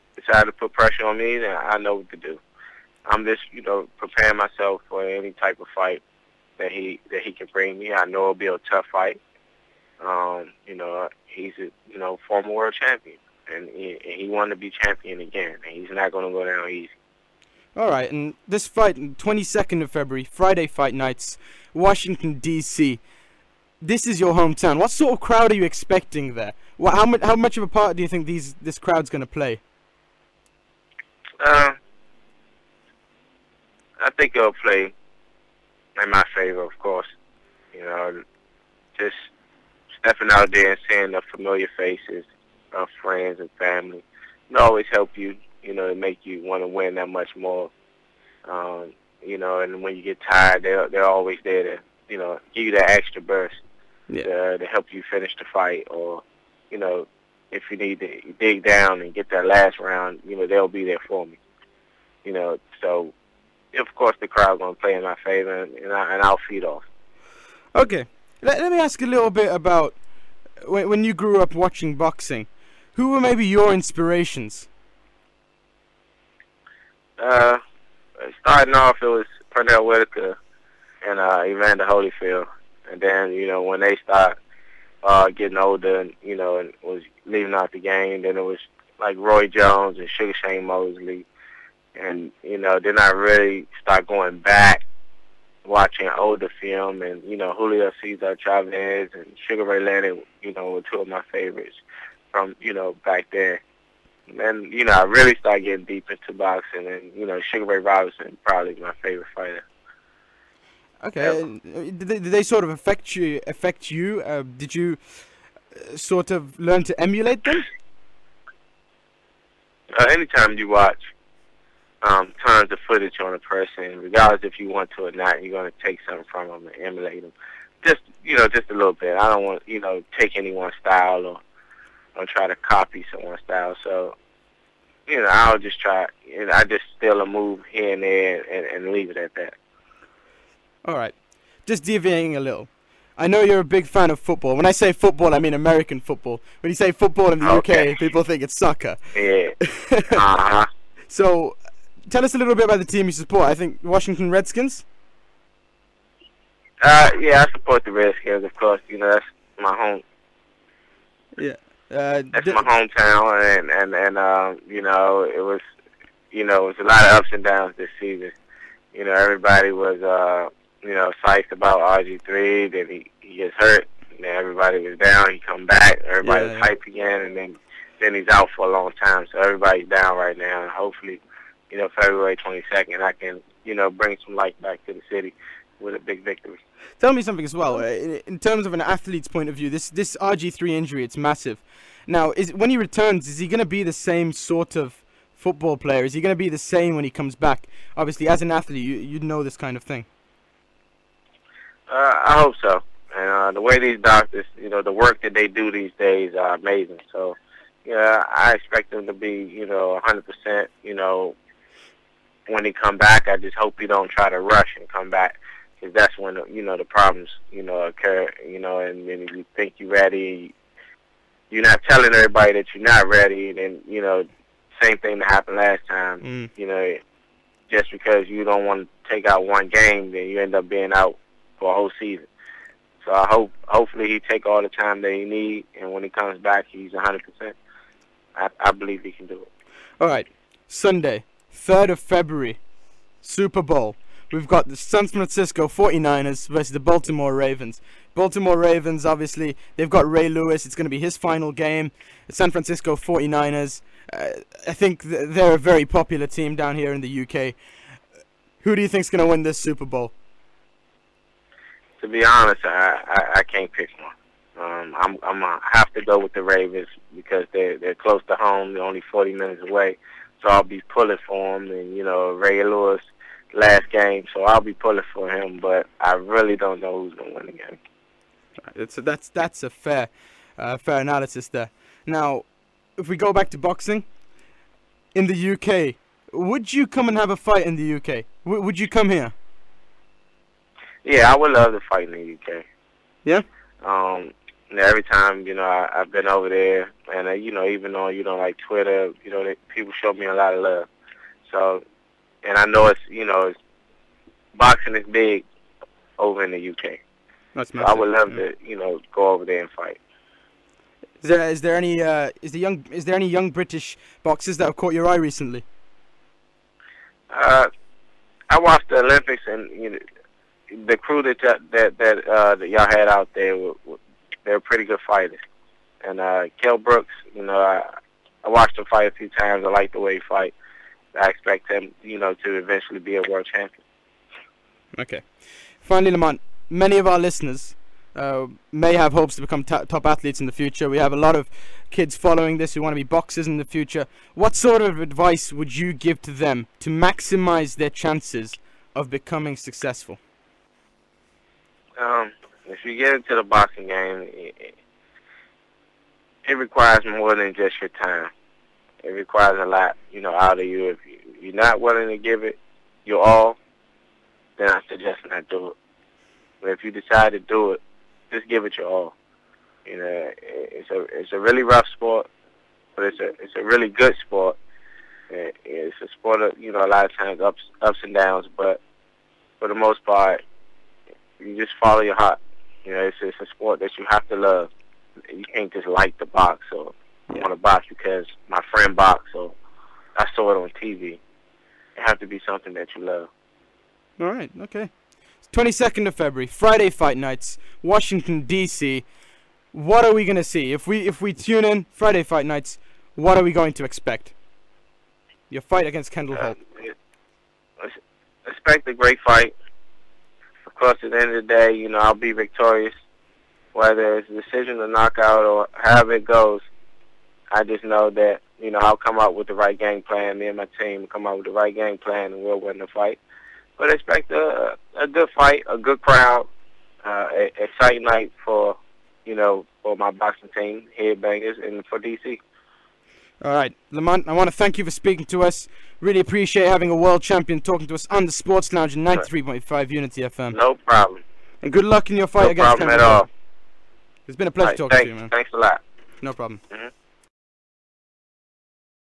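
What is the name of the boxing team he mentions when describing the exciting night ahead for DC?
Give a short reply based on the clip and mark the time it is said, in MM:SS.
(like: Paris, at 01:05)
Headbangers, at 07:10.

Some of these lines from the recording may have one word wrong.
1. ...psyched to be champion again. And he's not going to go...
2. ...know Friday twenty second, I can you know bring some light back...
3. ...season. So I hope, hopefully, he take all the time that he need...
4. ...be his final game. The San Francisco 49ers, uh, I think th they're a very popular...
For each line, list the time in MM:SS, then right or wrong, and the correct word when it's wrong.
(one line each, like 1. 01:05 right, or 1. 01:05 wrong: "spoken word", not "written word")
1. 00:14 wrong: "wanted", not "psyched"
2. 03:01 wrong: "February", not "Friday"
3. 03:51 right
4. 04:10 right.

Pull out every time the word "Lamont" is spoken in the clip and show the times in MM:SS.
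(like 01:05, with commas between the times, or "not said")
05:36, 07:13.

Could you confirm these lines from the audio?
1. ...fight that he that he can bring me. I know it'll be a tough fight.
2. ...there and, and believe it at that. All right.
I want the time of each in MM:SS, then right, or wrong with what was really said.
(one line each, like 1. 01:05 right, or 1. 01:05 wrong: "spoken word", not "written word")
1. 00:05 right
2. 02:18 wrong: "leave", not "believe".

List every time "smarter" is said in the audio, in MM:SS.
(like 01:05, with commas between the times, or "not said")
not said.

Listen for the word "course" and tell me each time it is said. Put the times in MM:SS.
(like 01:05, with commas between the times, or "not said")
00:36, 01:03, 02:38, 06:50.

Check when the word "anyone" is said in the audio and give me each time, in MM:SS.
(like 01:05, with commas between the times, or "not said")
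02:10.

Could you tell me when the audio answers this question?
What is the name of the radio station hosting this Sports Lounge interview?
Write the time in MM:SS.
07:19.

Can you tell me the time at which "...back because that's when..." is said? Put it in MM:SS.
03:35.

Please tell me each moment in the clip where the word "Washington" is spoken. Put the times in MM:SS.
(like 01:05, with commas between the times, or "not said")
00:21, 02:33, 06:37.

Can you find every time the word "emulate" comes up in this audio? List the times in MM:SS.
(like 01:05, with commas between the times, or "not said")
01:56, 02:06.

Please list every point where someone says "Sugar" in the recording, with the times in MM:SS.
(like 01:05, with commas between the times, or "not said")
01:30, 01:39, 01:47.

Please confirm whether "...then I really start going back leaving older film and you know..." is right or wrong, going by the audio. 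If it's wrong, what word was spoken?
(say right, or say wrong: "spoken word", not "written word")
wrong: "watching", not "leaving".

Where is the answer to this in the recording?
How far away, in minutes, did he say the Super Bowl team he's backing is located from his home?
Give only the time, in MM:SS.
04:29.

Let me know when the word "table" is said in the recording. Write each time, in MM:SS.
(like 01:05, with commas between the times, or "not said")
not said.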